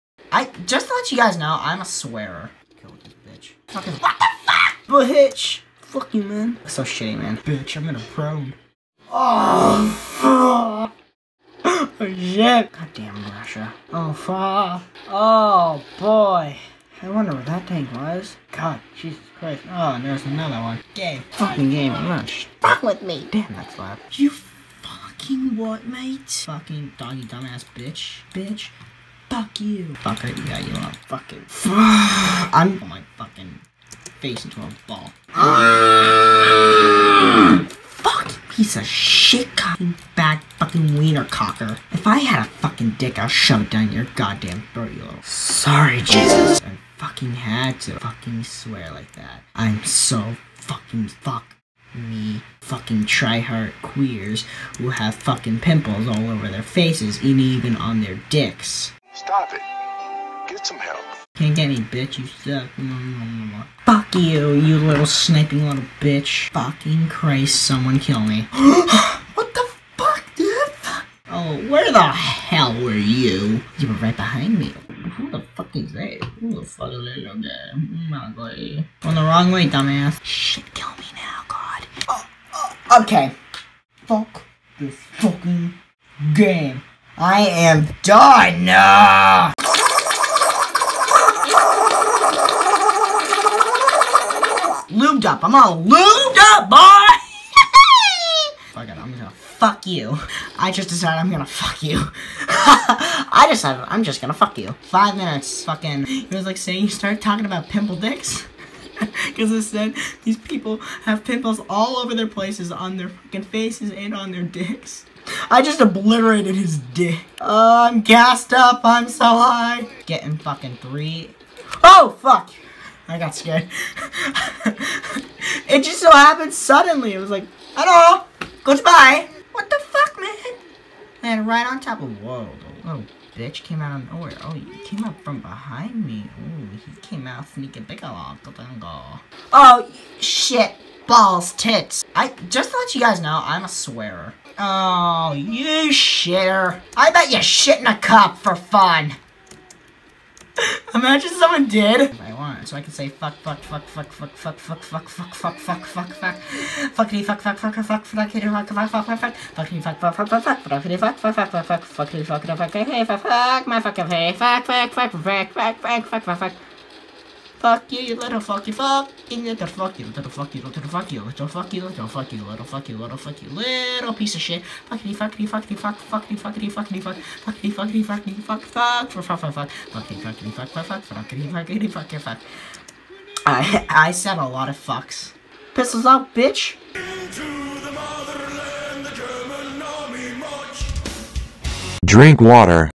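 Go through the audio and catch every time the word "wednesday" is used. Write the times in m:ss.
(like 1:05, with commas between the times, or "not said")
not said.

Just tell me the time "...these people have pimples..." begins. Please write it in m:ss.
1:50.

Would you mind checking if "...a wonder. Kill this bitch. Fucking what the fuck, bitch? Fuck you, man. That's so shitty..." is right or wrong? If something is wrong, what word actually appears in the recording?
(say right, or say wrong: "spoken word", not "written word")
wrong: "swearer", not "wonder".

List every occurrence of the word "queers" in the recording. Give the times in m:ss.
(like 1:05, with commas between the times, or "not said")
0:53.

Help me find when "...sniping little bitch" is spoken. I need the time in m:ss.
1:05.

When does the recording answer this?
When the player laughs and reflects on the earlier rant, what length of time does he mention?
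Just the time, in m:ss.
1:44.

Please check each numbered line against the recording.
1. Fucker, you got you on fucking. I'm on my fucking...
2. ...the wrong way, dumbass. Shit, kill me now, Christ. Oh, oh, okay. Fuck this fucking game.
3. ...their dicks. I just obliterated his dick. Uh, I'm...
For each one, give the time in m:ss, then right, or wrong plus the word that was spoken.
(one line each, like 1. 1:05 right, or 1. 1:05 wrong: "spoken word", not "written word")
1. 0:30 right
2. 1:19 wrong: "God", not "Christ"
3. 1:54 right.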